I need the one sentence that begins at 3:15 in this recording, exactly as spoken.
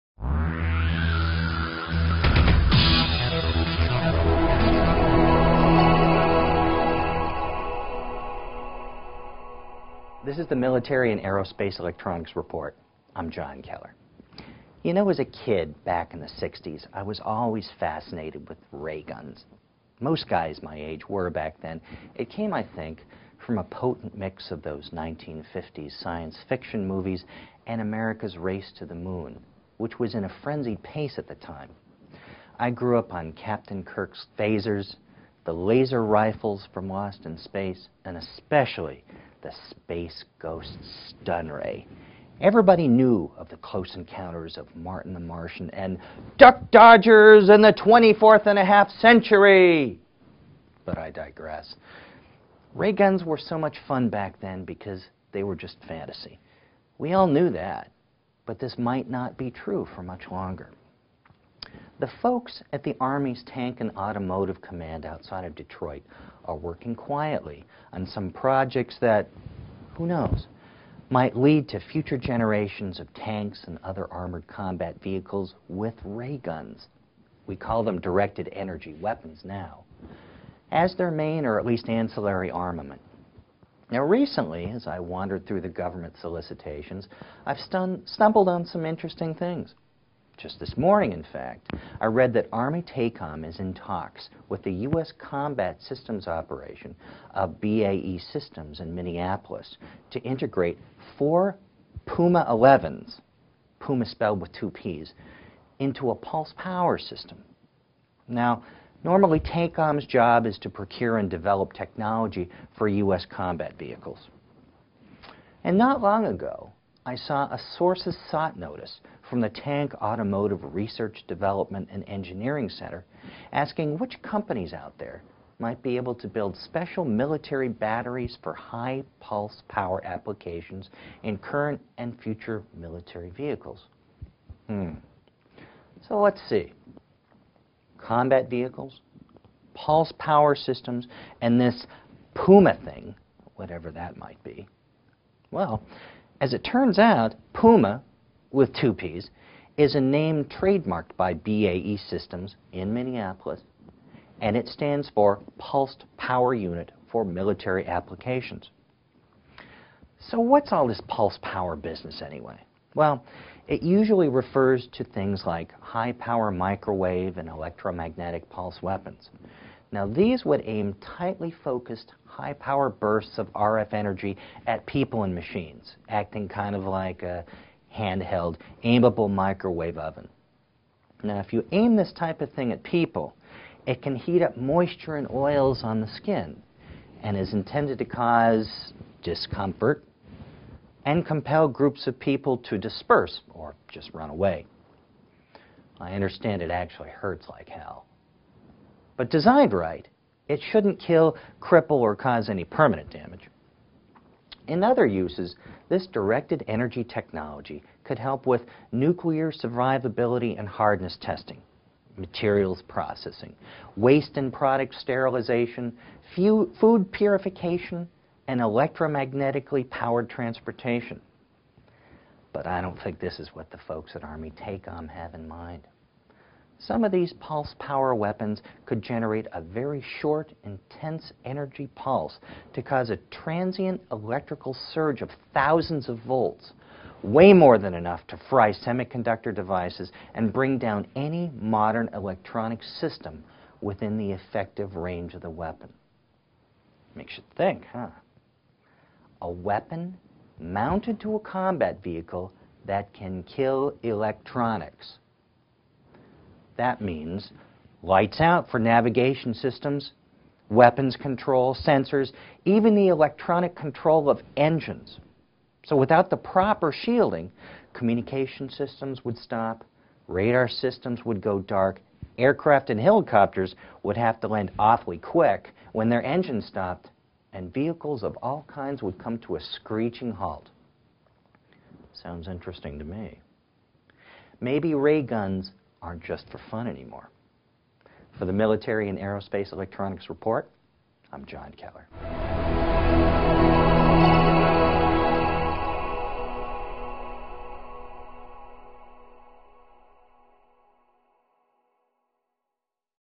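I understand it actually hurts like hell.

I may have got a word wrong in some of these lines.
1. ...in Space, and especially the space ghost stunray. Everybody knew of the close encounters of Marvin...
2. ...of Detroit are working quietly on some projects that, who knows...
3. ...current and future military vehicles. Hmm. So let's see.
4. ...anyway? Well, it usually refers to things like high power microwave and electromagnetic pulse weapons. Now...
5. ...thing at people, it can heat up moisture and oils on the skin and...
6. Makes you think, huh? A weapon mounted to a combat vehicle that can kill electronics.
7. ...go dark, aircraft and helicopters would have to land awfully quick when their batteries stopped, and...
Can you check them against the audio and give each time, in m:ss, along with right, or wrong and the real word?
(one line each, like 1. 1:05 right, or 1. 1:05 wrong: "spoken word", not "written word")
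1. 0:37 right
2. 1:05 right
3. 2:11 right
4. 2:42 right
5. 3:02 right
6. 4:07 right
7. 4:31 wrong: "engines", not "batteries".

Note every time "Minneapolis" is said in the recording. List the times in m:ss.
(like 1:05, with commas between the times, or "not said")
1:38, 2:32.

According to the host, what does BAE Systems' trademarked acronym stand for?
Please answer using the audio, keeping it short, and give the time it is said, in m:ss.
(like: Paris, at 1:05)
Pulsed Power Unit for Military Applications, at 2:35.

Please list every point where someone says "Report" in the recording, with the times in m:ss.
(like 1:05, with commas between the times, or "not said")
0:12, 4:50.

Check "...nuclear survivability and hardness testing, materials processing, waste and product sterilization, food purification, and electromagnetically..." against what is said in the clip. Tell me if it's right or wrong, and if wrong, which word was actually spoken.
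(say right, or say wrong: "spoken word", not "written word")
right.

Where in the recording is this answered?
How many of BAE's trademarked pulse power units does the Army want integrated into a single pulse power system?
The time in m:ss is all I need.
1:41.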